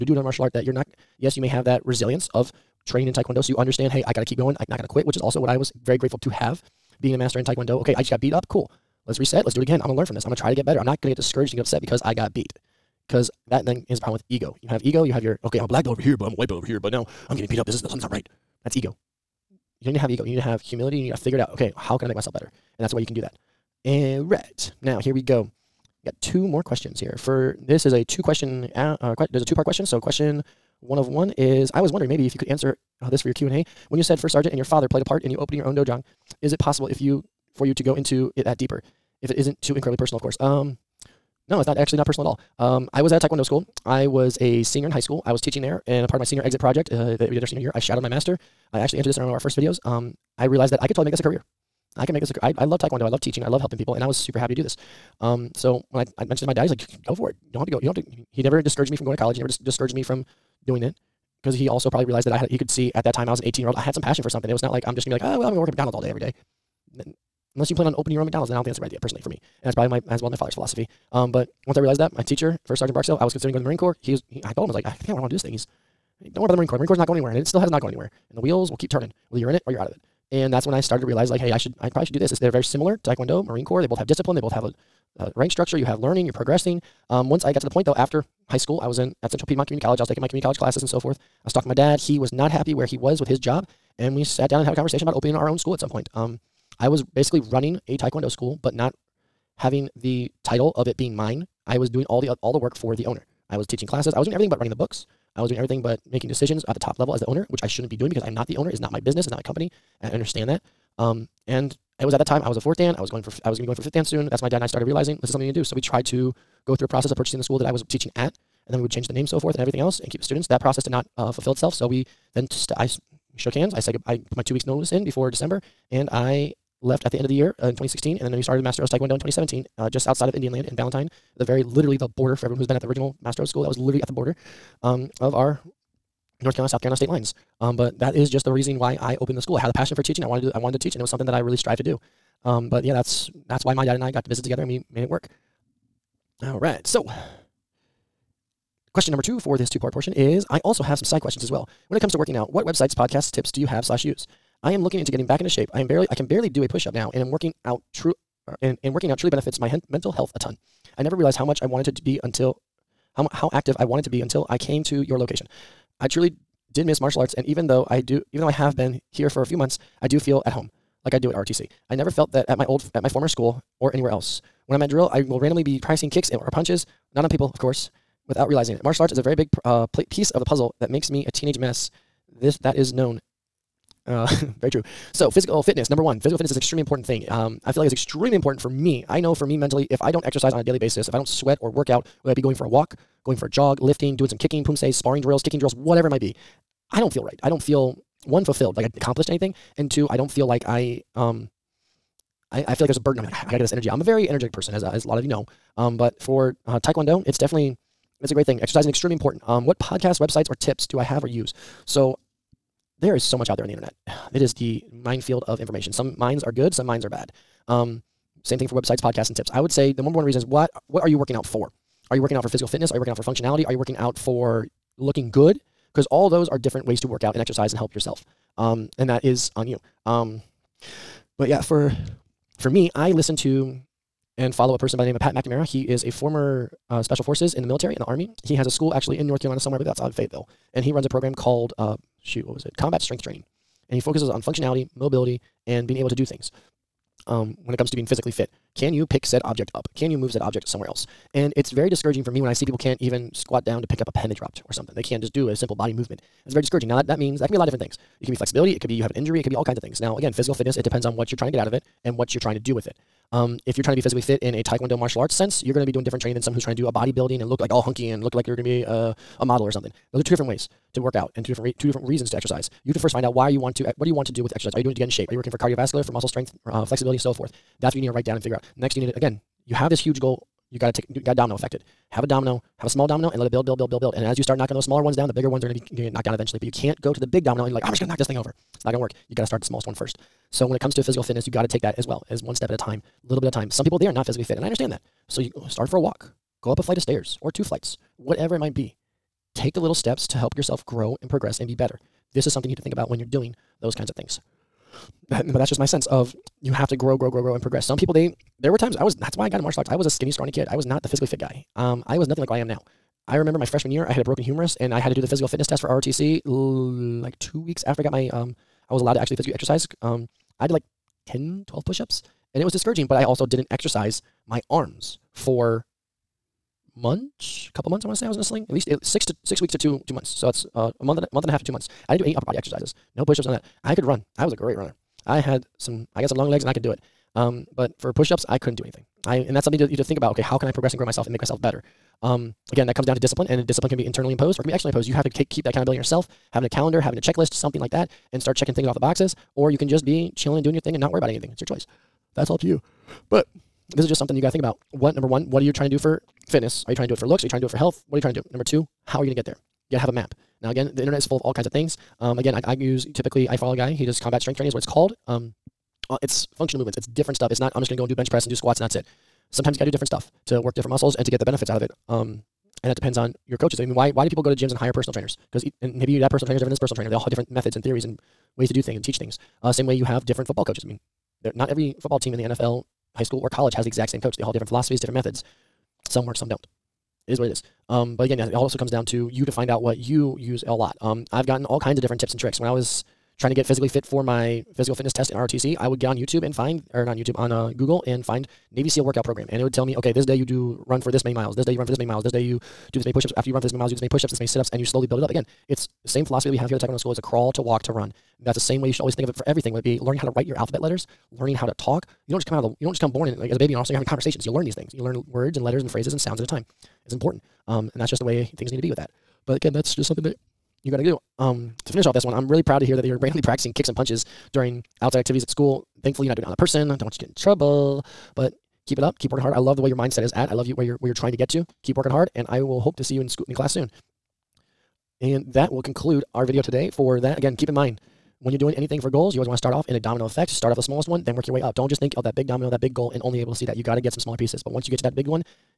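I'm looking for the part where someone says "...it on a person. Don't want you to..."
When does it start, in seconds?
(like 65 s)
426 s.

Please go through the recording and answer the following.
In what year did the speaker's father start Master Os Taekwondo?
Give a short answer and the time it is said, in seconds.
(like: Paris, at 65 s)
2017, at 129 s.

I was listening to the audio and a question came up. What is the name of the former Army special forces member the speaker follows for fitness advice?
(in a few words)
Pat McNamara.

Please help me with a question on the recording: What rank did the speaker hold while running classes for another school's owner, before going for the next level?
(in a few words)
fourth dan.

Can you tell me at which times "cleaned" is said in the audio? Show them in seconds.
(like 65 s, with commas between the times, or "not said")
not said.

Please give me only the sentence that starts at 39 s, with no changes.
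If it isn't too incredibly personal, of course.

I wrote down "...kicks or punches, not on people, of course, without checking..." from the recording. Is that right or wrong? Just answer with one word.
wrong.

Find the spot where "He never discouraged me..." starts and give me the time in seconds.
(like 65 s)
58 s.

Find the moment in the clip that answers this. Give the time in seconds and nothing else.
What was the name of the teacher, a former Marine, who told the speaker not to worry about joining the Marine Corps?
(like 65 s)
72 s.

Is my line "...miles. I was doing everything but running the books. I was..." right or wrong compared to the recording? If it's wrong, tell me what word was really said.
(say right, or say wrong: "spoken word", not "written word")
wrong: "classes", not "miles".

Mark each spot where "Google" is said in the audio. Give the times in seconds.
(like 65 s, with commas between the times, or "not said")
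397 s.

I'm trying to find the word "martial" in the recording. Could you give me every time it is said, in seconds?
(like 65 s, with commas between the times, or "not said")
0 s, 166 s, 178 s, 264 s, 309 s.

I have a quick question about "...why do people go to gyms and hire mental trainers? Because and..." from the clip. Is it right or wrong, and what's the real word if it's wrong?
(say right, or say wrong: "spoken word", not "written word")
wrong: "personal", not "mental".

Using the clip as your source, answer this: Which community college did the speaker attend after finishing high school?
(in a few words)
Central Piedmont Community College.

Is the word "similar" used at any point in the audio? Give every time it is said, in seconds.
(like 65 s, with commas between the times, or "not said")
82 s.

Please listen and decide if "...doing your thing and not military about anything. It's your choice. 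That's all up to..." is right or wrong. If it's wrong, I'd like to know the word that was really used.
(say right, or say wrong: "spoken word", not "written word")
wrong: "worry", not "military".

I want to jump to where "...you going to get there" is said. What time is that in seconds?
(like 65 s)
359 s.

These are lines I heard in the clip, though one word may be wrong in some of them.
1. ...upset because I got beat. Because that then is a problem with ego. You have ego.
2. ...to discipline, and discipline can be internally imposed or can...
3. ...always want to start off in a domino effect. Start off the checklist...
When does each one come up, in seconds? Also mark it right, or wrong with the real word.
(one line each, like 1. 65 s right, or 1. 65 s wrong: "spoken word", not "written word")
1. 11 s right
2. 343 s right
3. 439 s wrong: "smallest", not "checklist".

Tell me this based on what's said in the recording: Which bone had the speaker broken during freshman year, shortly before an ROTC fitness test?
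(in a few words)
humerus.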